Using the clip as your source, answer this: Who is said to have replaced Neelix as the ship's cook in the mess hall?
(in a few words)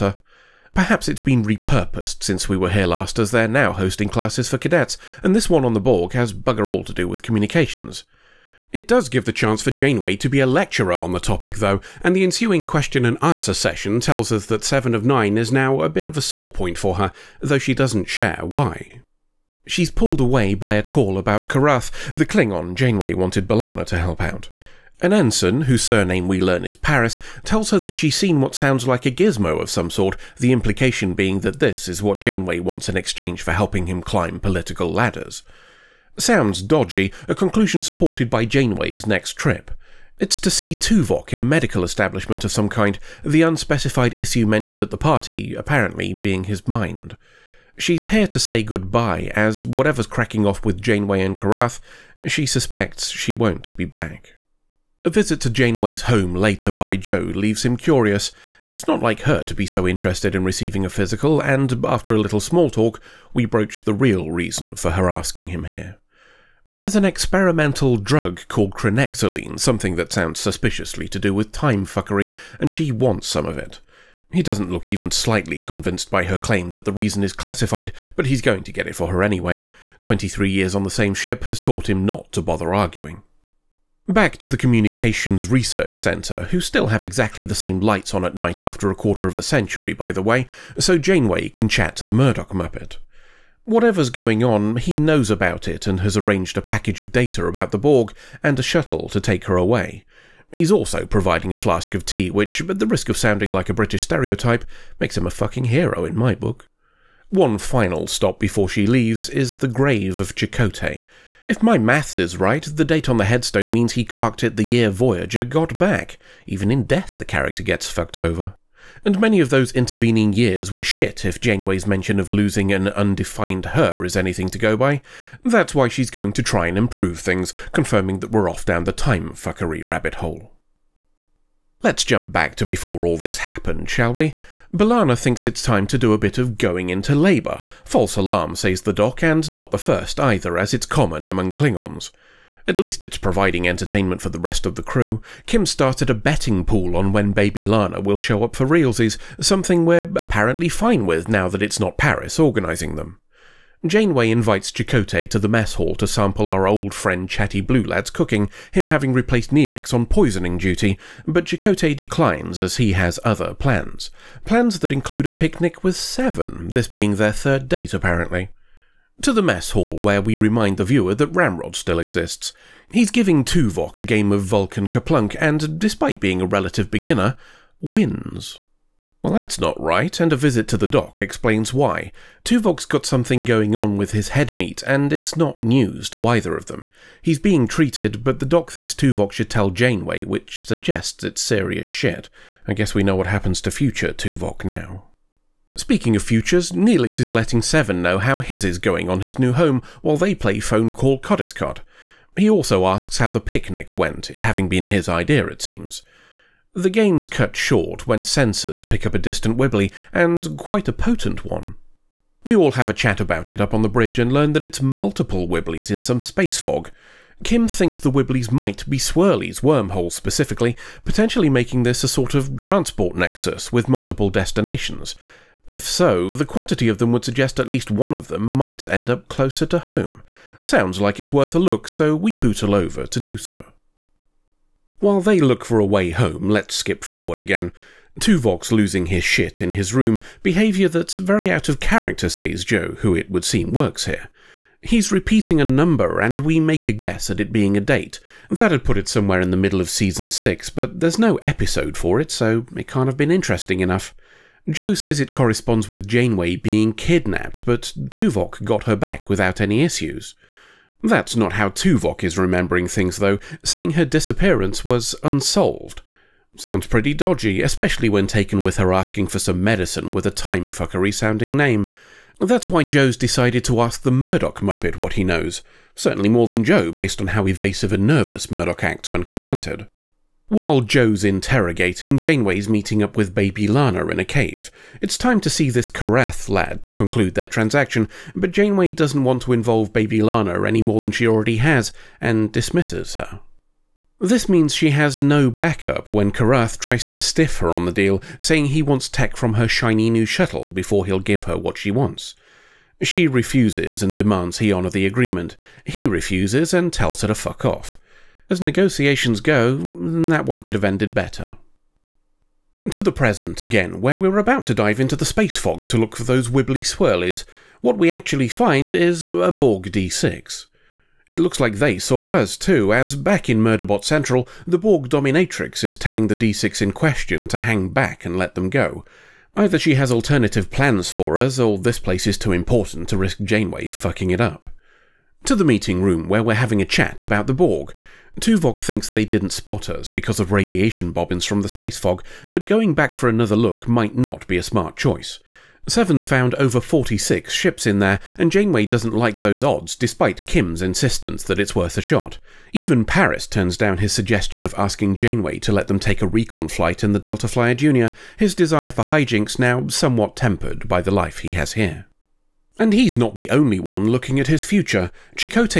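Chatty Blue Lad.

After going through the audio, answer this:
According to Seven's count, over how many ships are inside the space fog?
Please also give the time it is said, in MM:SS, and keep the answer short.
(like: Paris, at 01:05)
46, at 05:46.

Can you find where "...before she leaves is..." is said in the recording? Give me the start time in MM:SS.
01:48.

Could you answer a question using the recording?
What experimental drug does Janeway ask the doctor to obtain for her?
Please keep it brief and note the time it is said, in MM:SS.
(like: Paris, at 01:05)
chronexoline, at 01:08.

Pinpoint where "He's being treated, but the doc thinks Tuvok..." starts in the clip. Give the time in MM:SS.
03:07.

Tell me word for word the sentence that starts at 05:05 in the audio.
He refuses and tells her to fuck off.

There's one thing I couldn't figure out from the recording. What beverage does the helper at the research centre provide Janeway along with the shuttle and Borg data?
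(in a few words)
tea.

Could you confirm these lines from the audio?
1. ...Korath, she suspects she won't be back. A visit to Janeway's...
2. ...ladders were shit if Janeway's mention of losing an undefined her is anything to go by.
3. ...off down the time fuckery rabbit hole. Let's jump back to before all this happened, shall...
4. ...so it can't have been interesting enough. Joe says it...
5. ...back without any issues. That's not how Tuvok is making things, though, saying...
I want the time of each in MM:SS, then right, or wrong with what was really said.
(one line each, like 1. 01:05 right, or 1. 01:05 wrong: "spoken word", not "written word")
1. 00:51 right
2. 02:00 wrong: "years", not "ladders"
3. 02:08 right
4. 04:12 right
5. 04:18 wrong: "remembering", not "making".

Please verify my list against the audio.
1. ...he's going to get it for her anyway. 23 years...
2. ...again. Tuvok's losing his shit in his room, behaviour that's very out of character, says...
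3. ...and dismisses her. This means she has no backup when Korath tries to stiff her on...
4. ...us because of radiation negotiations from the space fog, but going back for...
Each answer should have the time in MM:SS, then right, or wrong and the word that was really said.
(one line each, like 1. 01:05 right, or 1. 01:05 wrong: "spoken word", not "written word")
1. 01:18 right
2. 03:57 right
3. 04:52 right
4. 05:39 wrong: "bobbins", not "negotiations".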